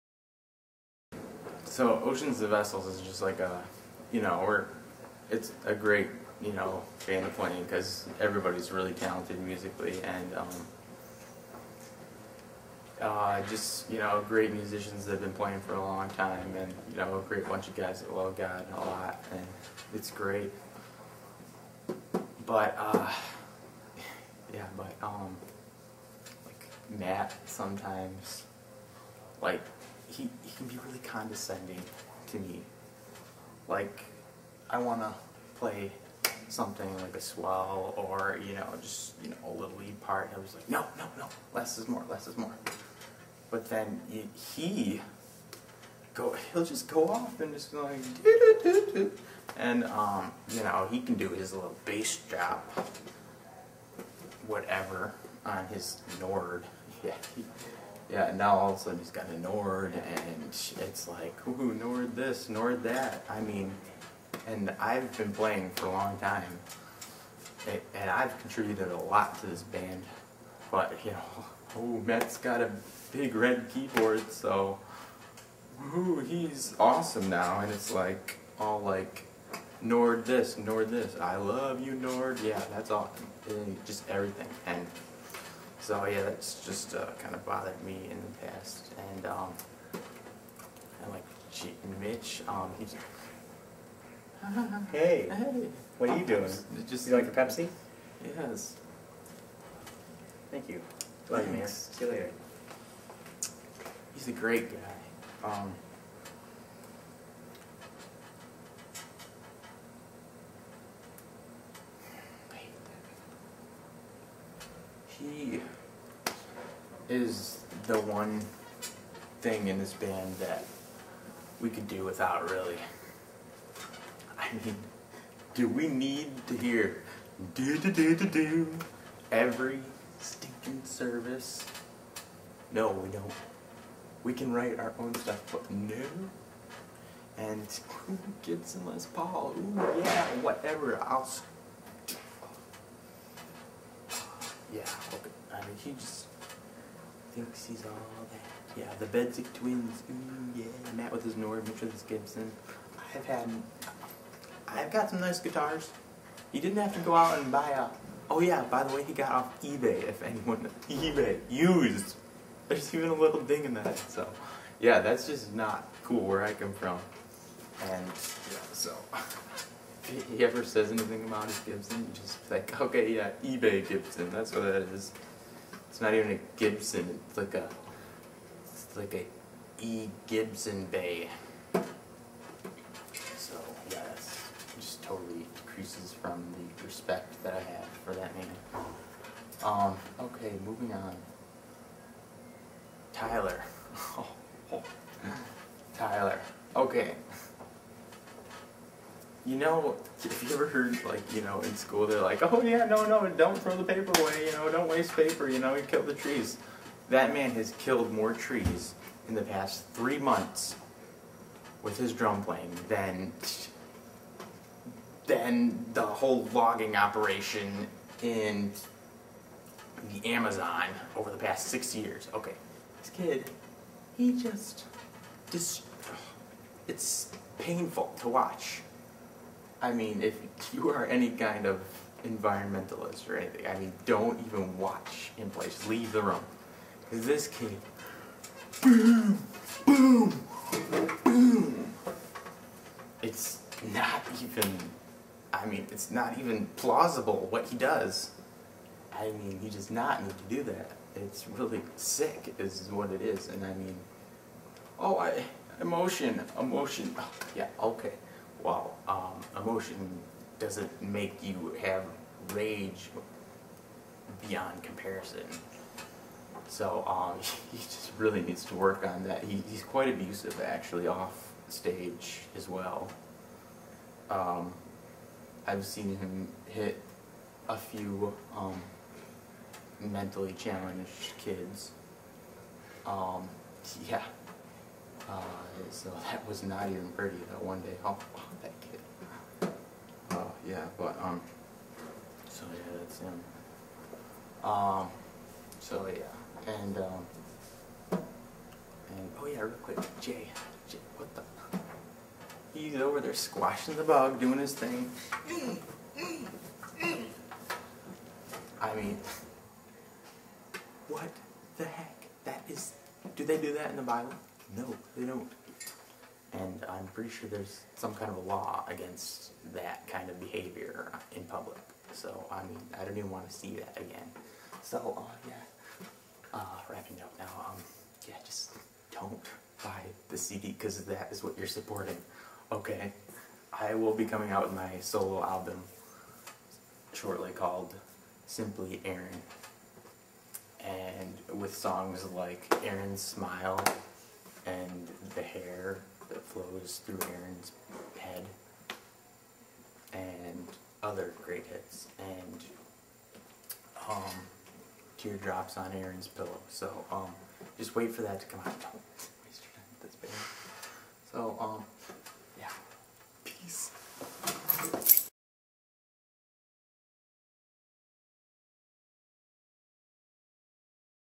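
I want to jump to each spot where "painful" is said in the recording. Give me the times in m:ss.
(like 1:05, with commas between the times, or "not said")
3:47.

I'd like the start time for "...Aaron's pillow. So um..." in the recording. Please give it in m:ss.
5:55.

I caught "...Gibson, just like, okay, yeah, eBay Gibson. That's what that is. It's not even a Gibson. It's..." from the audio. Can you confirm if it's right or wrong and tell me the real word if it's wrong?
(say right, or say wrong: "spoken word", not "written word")
right.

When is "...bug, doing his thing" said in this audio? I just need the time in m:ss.
5:04.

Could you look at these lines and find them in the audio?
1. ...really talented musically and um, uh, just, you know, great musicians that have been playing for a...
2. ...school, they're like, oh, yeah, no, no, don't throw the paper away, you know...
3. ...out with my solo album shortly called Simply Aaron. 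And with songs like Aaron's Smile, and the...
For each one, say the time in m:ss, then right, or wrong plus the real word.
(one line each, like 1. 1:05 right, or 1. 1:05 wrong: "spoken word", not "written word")
1. 0:08 right
2. 3:21 right
3. 5:34 right.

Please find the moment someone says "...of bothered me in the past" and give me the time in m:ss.
1:27.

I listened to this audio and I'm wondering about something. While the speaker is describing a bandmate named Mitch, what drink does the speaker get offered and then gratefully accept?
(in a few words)
Pepsi.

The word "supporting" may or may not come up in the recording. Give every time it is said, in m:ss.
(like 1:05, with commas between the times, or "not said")
5:31.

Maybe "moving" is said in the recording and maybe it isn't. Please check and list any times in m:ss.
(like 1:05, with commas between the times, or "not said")
3:10.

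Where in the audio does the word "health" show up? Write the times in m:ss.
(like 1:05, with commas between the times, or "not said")
not said.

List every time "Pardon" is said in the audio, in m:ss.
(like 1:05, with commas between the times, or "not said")
not said.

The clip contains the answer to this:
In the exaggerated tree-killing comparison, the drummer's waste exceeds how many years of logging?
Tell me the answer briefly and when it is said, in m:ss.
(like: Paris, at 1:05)
6 years, at 3:41.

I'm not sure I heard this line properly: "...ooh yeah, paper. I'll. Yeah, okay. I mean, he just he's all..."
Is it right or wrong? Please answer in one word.
wrong.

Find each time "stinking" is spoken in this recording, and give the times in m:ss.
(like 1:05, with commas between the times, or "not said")
2:10.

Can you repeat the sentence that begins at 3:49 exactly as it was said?
I mean, if you are any kind of environmentalist or anything, I mean, don't even watch in place.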